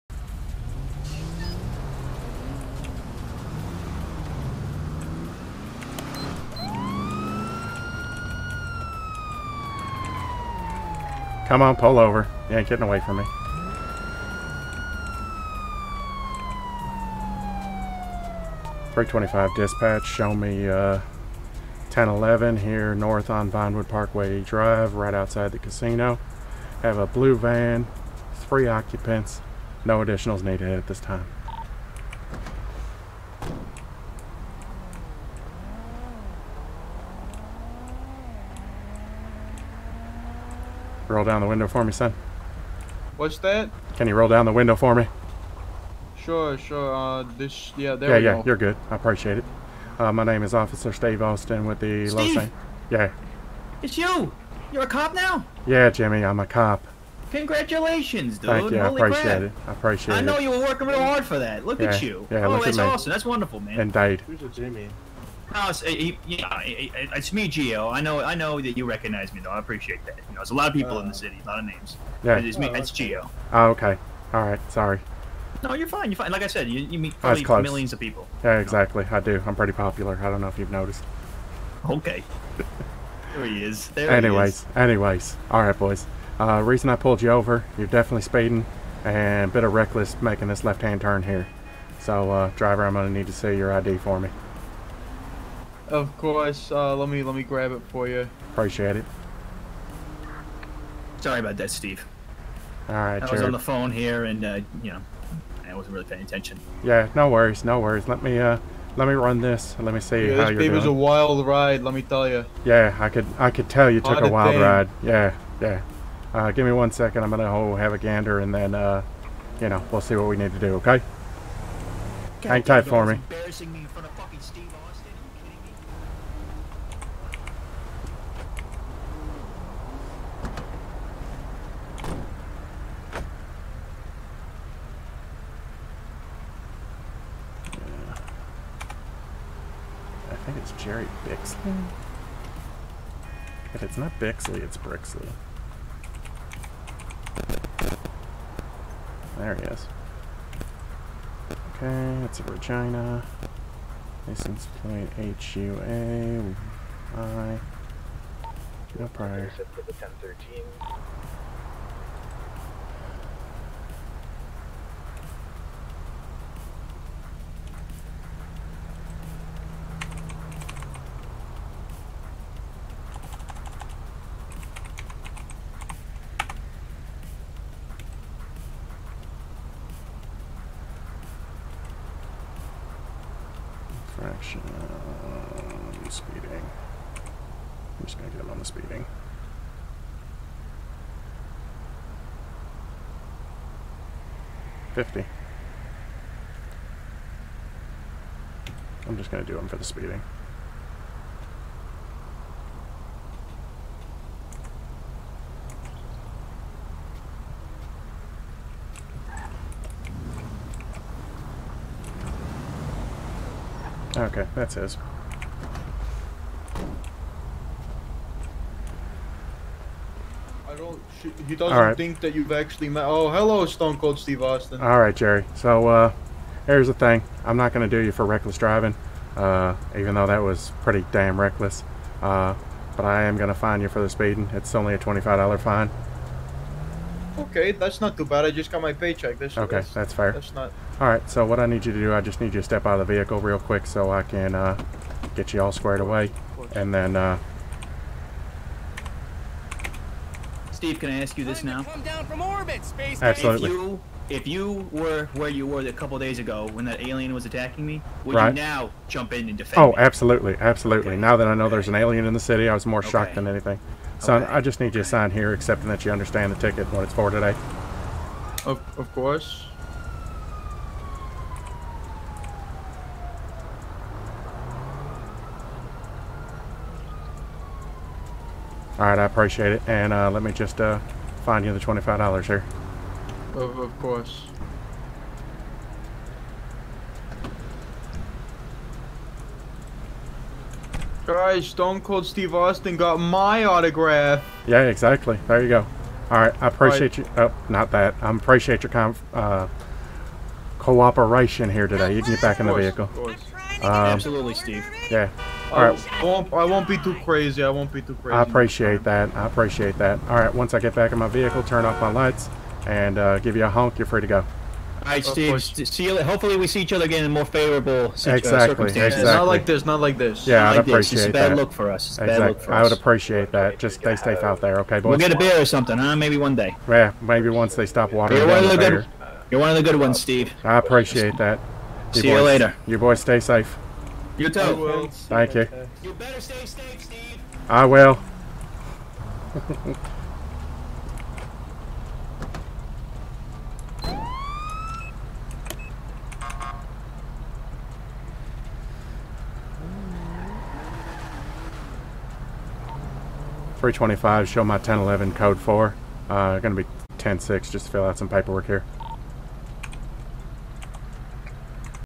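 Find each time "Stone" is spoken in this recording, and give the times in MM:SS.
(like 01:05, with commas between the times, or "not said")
03:43, 04:51.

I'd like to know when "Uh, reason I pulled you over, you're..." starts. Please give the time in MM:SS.
01:26.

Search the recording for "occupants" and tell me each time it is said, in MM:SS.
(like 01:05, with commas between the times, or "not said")
00:28.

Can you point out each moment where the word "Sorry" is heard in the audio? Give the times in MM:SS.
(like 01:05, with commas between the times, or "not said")
01:14, 01:41.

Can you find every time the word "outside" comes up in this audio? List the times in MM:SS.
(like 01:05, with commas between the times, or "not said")
00:25.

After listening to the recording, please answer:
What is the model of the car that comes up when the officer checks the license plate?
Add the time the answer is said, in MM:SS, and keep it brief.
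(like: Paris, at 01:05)
Regina, at 02:32.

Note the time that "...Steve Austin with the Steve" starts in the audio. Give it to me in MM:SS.
00:50.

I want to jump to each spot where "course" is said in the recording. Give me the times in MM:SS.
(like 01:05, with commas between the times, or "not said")
01:36, 04:29, 04:43.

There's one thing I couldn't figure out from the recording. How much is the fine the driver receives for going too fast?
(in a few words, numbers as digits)
$25.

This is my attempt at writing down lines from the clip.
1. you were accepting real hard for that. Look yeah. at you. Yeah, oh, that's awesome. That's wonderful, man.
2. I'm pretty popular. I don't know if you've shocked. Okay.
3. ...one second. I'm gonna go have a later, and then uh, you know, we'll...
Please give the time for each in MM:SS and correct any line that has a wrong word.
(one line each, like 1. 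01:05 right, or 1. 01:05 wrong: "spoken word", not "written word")
1. 01:00 wrong: "working", not "accepting"
2. 01:19 wrong: "noticed", not "shocked"
3. 01:56 wrong: "gander", not "later".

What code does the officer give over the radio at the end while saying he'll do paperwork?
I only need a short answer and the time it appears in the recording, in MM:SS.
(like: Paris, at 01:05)
106, at 05:57.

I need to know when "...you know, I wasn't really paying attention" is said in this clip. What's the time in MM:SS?
01:44.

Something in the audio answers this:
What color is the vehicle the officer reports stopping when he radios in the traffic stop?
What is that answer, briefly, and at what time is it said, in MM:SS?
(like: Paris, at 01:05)
Blue, at 00:27.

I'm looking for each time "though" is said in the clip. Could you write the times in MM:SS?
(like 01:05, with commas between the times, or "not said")
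01:09, 03:50.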